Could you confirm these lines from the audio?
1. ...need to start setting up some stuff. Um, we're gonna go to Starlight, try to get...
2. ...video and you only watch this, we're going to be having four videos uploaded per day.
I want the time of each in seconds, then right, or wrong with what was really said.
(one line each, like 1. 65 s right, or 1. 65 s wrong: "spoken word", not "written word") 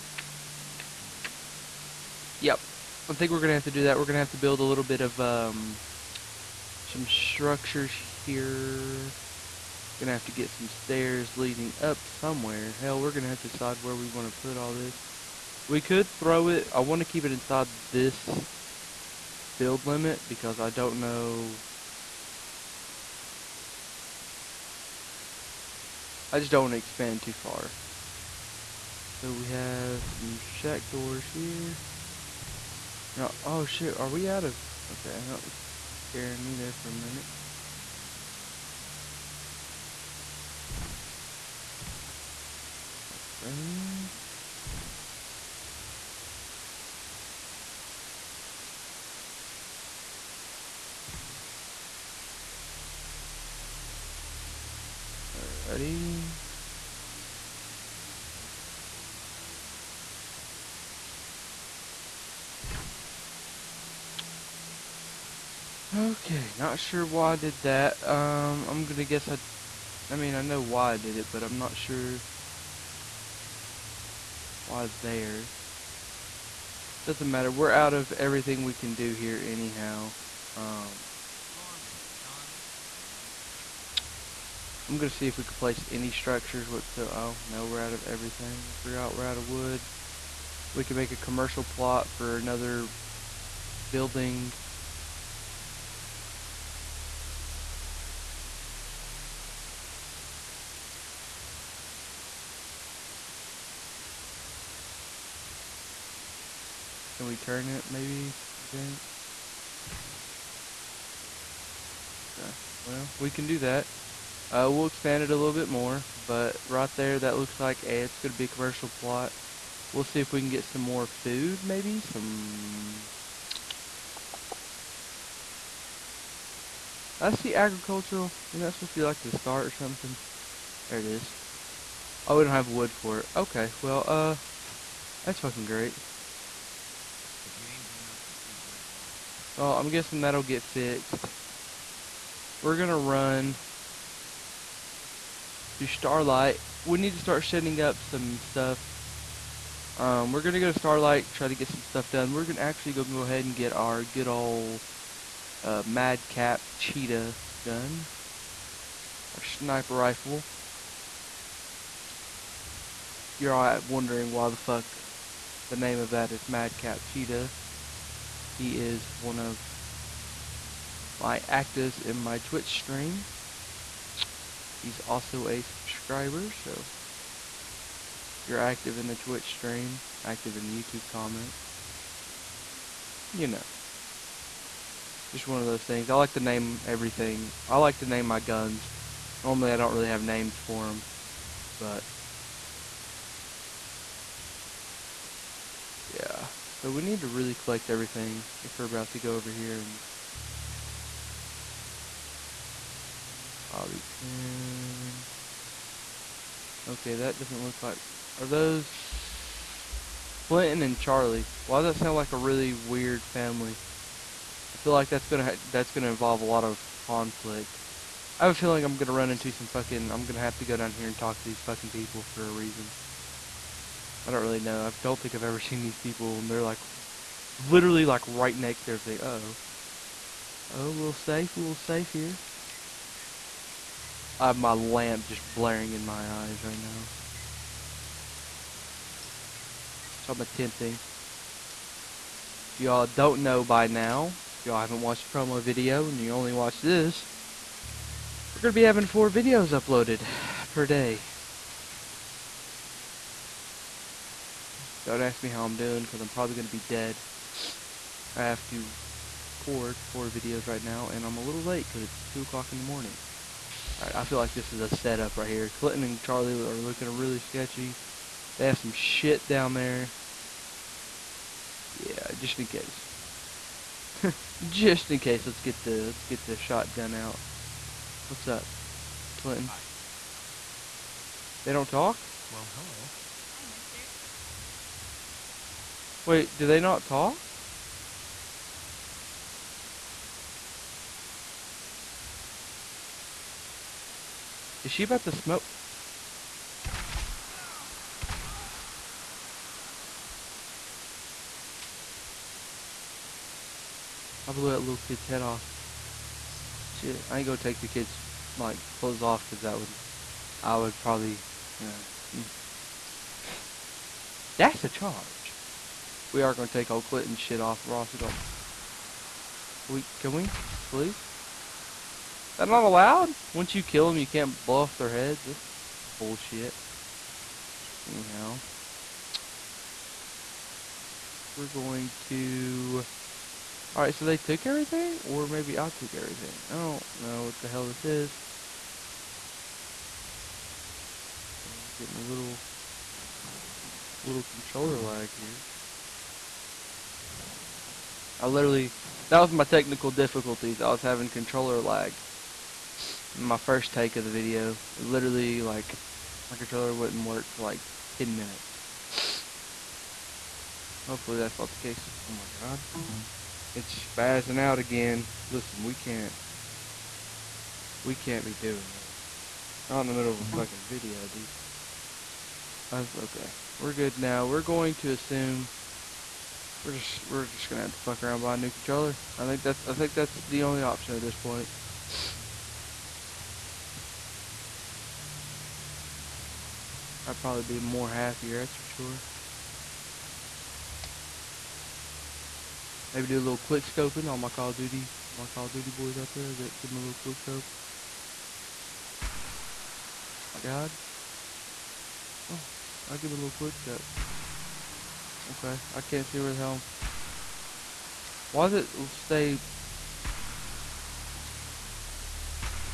1. 146 s right
2. 245 s right.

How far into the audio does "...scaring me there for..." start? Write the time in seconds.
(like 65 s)
36 s.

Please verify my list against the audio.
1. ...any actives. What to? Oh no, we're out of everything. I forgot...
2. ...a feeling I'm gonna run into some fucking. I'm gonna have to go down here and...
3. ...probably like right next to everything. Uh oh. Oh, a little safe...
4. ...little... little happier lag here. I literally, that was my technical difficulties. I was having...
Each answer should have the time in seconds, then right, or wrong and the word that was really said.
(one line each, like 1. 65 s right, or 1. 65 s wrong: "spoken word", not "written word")
1. 85 s wrong: "structures", not "actives"
2. 218 s right
3. 227 s wrong: "literally", not "probably"
4. 342 s wrong: "controller", not "happier".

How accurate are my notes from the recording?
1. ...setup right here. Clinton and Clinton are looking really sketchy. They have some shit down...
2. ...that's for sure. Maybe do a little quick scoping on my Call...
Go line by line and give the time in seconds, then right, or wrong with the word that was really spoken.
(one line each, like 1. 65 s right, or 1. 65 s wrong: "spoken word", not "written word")
1. 264 s wrong: "Charlie", not "Clinton"
2. 388 s right.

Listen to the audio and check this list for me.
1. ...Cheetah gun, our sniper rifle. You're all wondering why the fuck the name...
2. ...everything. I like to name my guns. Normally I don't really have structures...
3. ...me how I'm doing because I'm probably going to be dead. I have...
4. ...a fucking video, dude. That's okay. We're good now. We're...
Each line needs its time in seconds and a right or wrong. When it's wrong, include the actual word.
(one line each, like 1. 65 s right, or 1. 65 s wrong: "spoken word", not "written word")
1. 156 s right
2. 186 s wrong: "names", not "structures"
3. 255 s right
4. 370 s right.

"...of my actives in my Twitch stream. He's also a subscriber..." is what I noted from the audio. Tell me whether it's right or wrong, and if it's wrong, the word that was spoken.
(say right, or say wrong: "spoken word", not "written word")
right.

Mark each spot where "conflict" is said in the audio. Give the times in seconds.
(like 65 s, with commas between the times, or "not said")
217 s.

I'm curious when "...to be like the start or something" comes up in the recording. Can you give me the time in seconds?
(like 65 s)
128 s.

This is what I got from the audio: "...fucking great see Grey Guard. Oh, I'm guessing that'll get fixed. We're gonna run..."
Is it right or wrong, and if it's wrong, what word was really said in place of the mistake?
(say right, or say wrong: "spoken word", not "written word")
right.